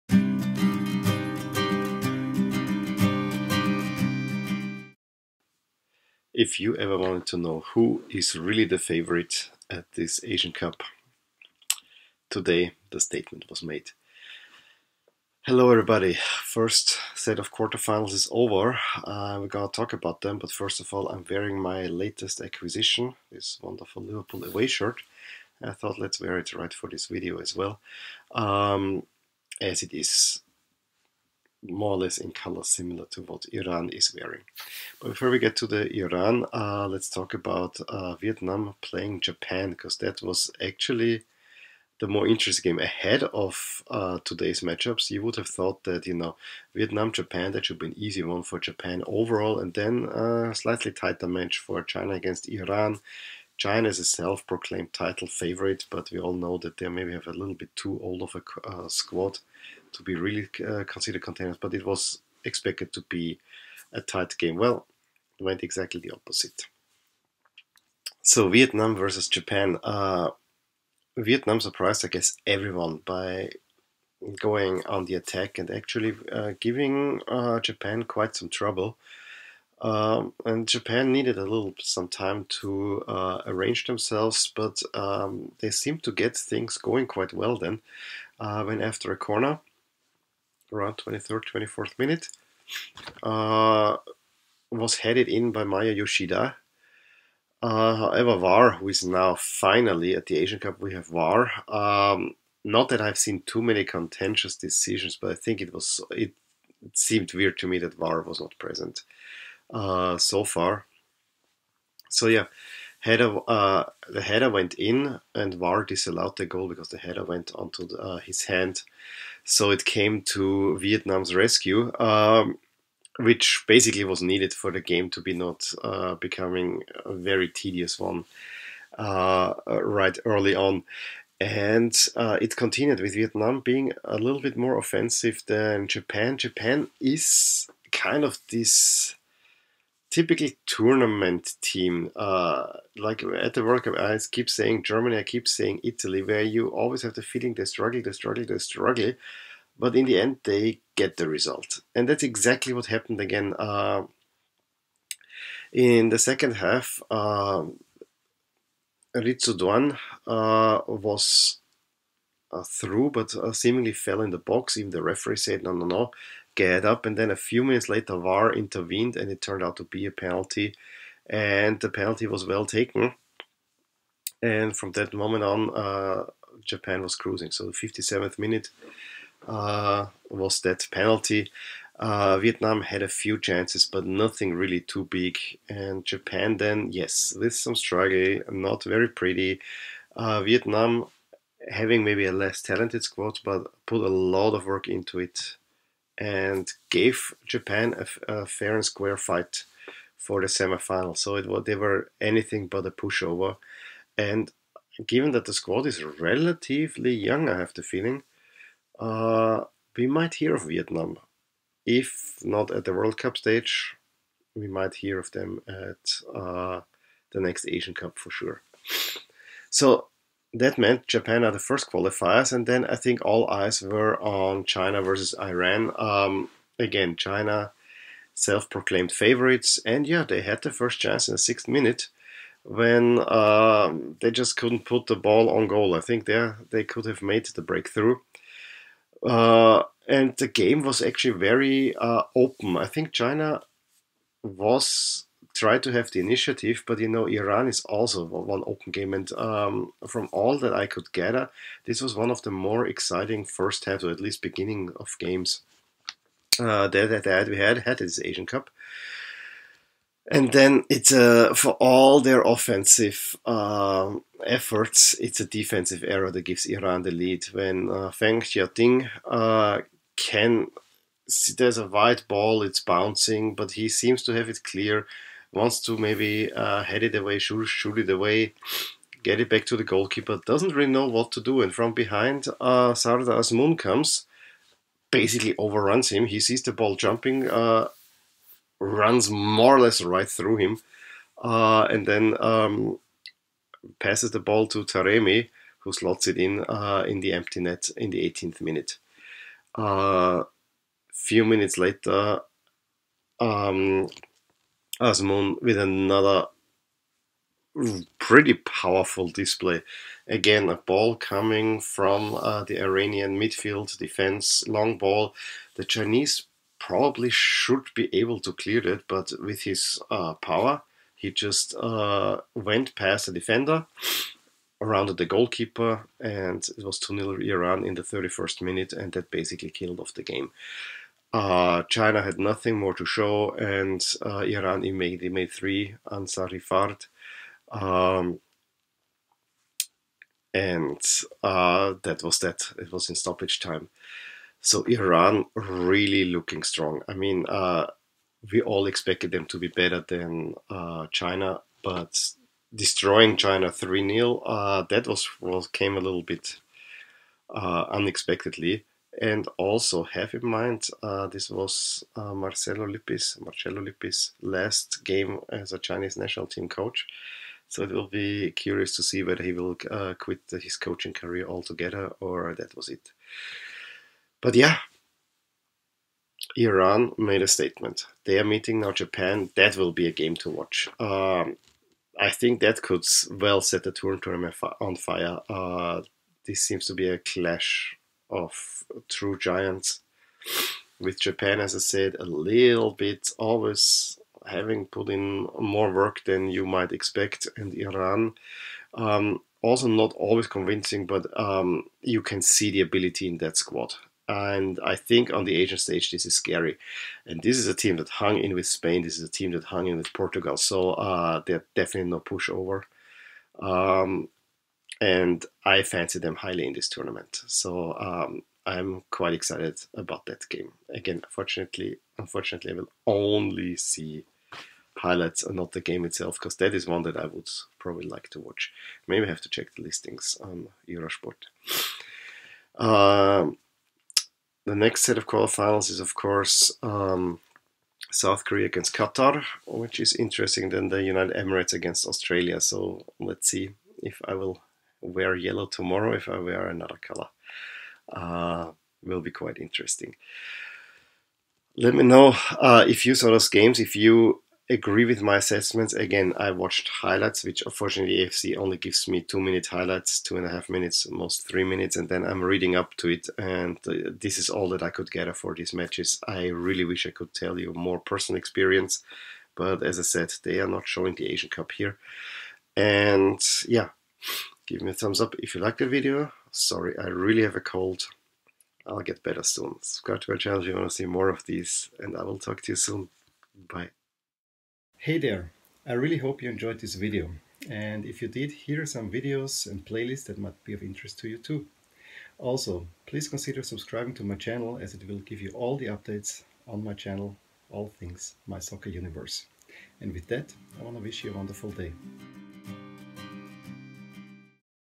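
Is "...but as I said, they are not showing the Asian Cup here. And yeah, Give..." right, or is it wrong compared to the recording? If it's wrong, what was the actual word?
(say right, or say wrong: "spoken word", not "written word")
right.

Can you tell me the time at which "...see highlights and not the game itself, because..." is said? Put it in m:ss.
7:03.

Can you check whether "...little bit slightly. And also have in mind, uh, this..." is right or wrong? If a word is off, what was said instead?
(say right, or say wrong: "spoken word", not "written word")
wrong: "unexpectedly", not "slightly".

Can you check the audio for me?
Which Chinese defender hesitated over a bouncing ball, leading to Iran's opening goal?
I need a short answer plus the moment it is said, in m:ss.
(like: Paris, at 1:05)
Feng Xiaoting, at 4:28.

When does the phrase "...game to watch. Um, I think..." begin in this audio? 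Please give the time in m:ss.
6:20.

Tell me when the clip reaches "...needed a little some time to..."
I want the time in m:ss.
1:21.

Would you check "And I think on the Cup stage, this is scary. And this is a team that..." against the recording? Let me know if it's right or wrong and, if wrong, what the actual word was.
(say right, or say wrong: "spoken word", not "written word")
wrong: "Asian", not "Cup".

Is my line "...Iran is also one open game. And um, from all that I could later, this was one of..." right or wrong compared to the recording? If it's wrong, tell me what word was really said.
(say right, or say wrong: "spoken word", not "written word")
wrong: "gather", not "later".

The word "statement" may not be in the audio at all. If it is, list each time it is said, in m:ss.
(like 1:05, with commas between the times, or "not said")
0:12, 6:17.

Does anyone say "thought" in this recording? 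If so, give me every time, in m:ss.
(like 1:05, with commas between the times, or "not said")
0:25, 0:45.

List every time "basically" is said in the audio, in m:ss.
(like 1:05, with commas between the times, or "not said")
2:03, 4:45, 5:29.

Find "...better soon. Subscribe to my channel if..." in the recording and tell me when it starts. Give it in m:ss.
7:59.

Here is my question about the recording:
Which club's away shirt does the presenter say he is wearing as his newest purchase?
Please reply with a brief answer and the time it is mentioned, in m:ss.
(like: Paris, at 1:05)
Liverpool, at 0:24.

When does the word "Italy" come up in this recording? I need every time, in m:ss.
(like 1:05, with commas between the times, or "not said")
2:25.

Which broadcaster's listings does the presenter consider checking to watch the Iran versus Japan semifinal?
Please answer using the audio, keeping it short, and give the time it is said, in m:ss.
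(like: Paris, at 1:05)
Eurosport, at 7:10.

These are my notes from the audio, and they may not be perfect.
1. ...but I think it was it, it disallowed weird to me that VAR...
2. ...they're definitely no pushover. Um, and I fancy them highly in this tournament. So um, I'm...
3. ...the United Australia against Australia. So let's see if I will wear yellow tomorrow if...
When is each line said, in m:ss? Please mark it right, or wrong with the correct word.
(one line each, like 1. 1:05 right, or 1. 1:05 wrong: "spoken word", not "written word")
1. 1:45 wrong: "seemed", not "disallowed"
2. 6:51 right
3. 7:20 wrong: "Emirates", not "Australia".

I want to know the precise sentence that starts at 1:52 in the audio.
So yeah, header uh, the header went in and VAR disallowed the goal because the header went onto the, uh, his hand.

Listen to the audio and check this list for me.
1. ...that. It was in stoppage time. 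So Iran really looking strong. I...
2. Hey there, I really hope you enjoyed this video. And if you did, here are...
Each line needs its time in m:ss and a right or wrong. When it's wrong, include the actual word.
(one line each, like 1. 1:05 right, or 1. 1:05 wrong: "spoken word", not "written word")
1. 5:42 right
2. 8:04 right.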